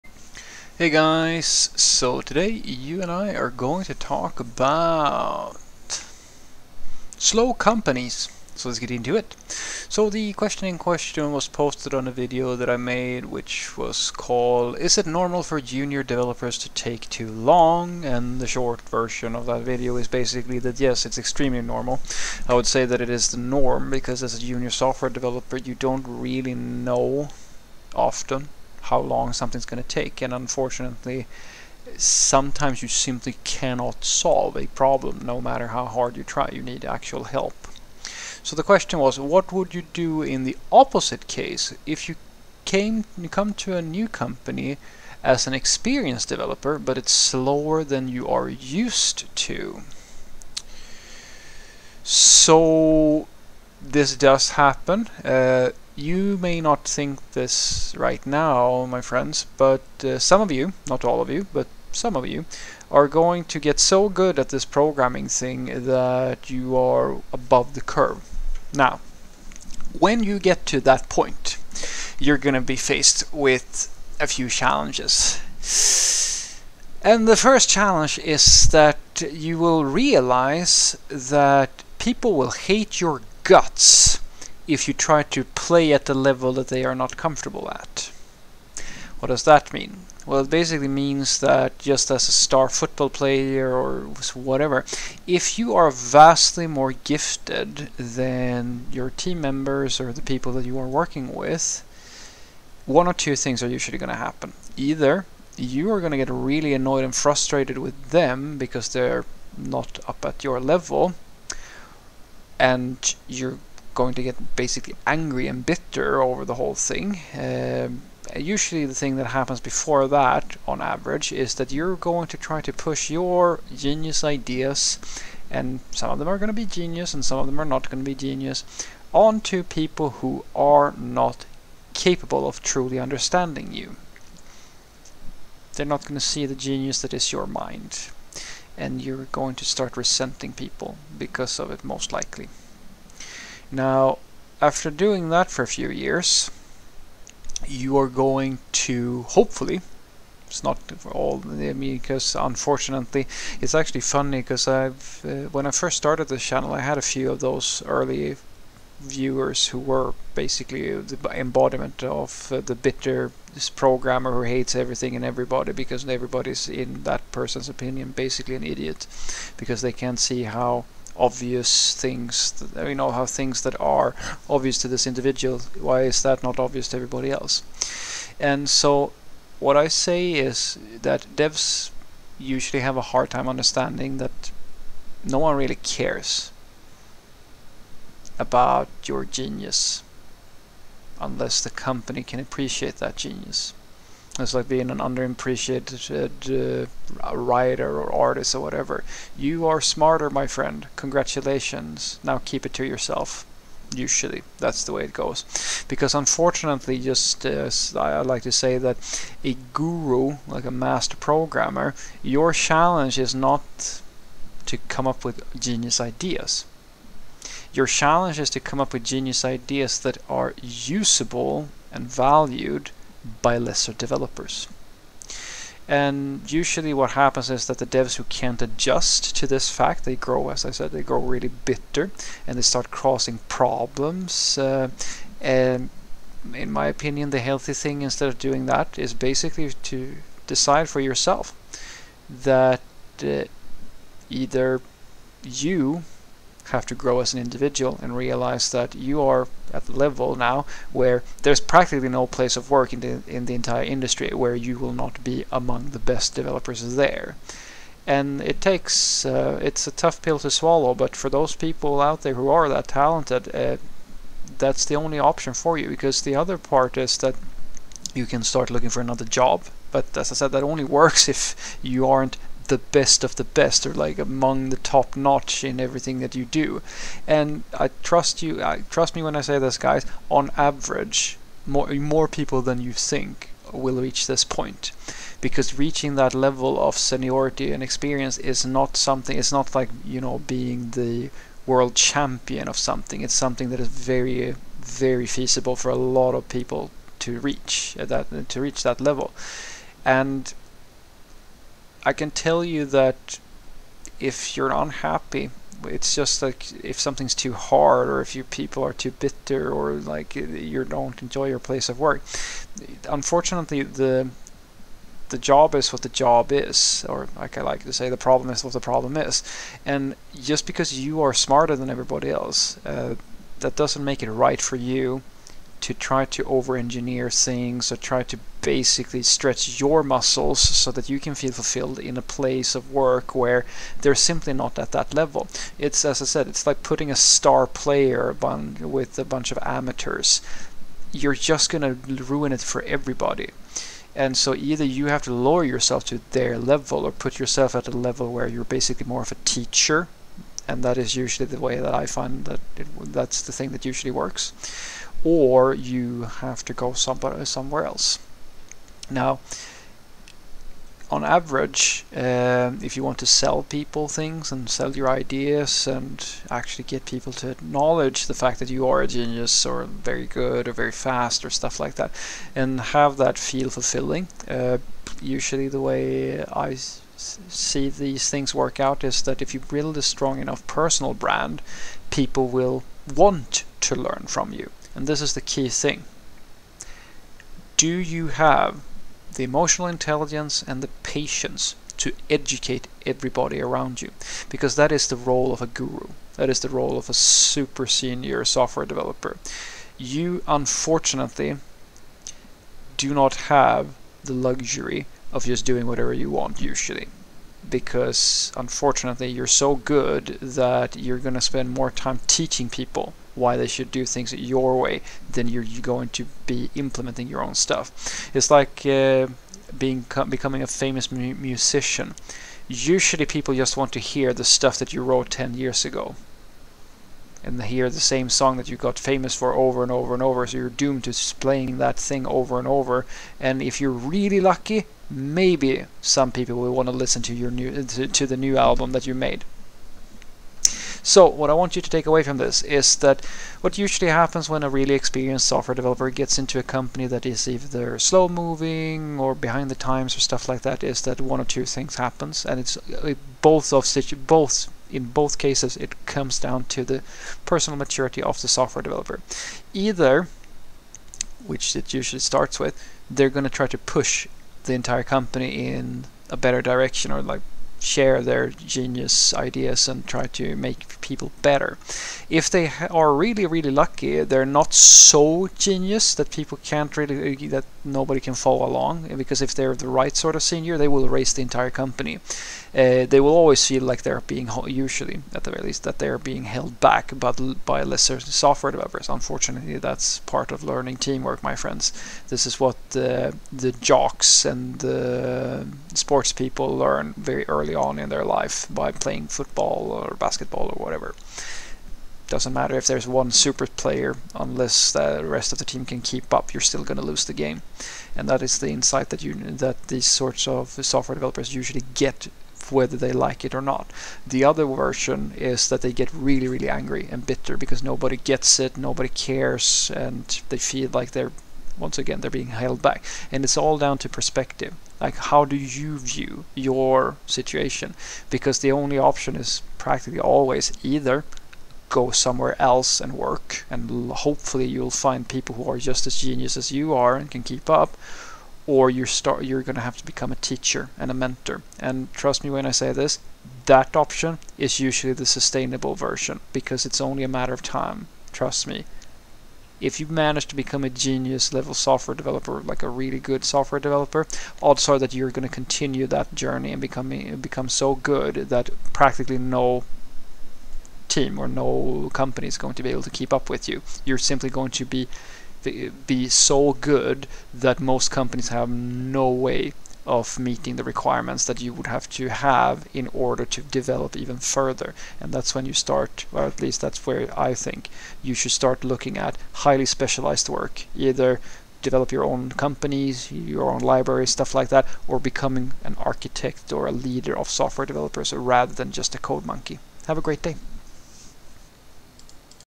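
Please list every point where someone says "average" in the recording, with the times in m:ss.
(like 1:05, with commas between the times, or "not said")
2:00, 4:40, 6:01.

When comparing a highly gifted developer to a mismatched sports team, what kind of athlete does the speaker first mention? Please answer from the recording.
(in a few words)
star football player.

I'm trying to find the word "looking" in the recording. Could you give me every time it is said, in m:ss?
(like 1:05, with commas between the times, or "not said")
4:28, 9:38.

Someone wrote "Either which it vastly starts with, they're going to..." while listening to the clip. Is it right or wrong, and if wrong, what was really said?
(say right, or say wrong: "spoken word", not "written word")
wrong: "usually", not "vastly".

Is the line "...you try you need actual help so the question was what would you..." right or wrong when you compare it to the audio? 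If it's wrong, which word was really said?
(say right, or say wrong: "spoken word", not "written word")
right.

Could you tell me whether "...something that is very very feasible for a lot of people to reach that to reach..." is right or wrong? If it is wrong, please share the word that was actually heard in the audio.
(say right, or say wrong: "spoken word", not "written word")
right.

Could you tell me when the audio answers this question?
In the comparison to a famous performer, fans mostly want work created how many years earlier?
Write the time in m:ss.
7:05.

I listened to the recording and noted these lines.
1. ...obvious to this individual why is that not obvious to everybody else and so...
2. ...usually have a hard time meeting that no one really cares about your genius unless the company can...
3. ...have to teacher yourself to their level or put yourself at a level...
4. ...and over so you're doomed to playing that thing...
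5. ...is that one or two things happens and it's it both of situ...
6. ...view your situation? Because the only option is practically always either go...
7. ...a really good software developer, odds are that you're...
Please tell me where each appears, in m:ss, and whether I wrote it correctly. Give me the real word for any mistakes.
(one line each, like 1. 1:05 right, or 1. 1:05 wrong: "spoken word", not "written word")
1. 2:54 right
2. 3:02 wrong: "understanding", not "meeting"
3. 5:45 wrong: "lower", not "teacher"
4. 7:10 right
5. 7:30 right
6. 8:45 right
7. 9:12 right.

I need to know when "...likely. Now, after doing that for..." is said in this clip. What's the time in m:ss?
2:22.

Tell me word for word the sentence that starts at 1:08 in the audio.
Now, when you get to that point, you're going to be faced with a few challenges.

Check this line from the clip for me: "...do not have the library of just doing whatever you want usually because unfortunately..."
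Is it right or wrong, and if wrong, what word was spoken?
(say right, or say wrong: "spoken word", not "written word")
wrong: "luxury", not "library".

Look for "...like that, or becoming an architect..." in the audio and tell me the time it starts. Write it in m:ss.
9:44.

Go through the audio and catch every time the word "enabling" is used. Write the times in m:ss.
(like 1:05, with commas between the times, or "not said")
not said.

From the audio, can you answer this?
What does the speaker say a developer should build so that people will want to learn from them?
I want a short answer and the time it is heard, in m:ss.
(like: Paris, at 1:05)
personal brand, at 6:20.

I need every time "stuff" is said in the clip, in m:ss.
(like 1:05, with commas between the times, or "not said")
6:11, 6:57, 7:04, 7:30, 9:44.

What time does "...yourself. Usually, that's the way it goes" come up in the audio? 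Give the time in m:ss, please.
3:22.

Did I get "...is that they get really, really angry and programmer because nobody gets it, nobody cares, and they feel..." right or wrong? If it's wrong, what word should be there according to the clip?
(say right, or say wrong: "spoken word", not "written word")
wrong: "bitter", not "programmer".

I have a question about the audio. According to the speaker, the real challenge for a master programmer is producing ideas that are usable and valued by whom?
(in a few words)
lesser developers.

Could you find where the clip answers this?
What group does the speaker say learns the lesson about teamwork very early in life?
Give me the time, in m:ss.
8:13.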